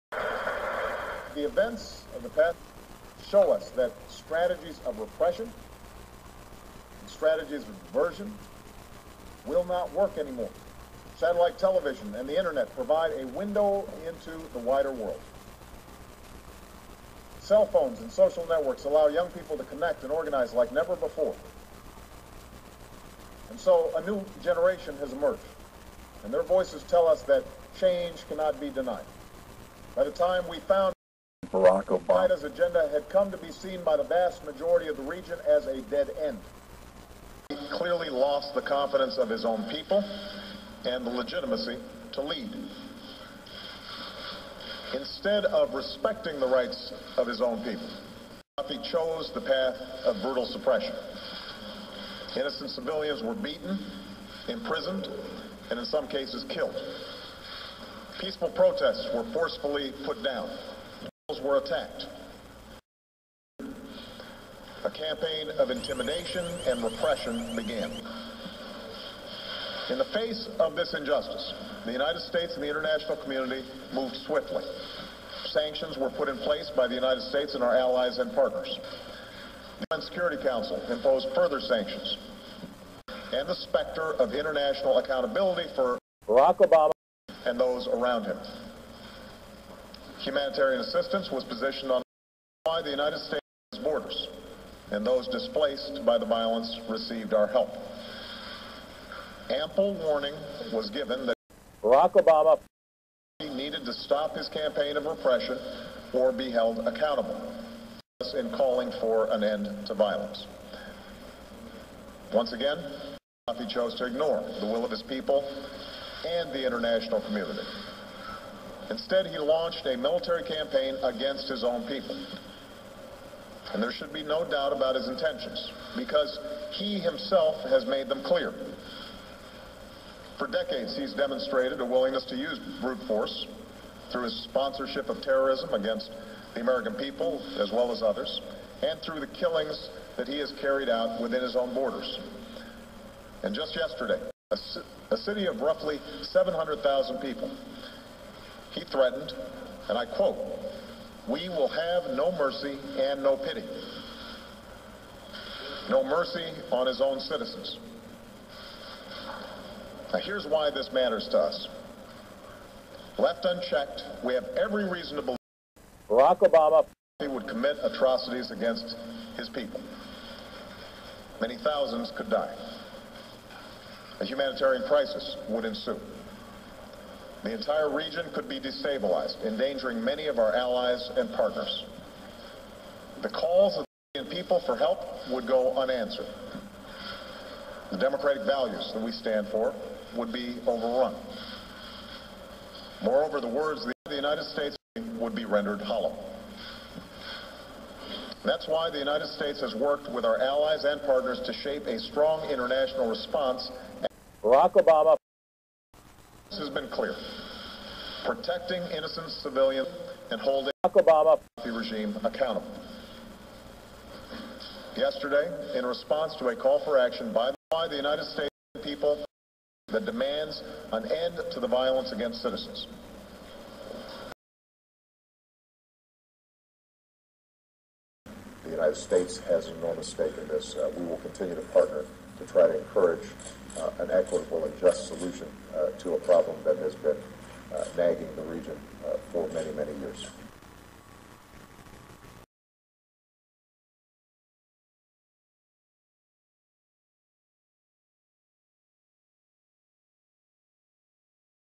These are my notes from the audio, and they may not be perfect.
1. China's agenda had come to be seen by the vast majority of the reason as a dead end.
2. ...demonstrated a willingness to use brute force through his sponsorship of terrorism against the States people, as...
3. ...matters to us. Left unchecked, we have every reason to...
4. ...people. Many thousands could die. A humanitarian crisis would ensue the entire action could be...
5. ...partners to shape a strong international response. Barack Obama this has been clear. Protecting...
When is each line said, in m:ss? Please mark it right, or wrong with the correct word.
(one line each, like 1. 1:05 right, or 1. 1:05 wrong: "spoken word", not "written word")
1. 0:32 wrong: "region", not "reason"
2. 2:11 wrong: "American", not "States"
3. 2:40 right
4. 2:49 wrong: "region", not "action"
5. 3:21 right.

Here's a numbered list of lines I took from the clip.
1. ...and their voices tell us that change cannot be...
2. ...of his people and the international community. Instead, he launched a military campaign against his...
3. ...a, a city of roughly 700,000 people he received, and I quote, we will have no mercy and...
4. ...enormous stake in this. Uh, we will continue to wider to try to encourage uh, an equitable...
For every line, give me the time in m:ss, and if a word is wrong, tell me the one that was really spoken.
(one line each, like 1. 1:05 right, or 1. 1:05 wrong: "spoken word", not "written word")
1. 0:26 right
2. 1:54 right
3. 2:24 wrong: "threatened", not "received"
4. 3:49 wrong: "partner", not "wider".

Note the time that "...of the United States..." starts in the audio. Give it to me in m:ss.
3:13.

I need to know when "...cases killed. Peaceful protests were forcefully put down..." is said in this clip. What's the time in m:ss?
0:56.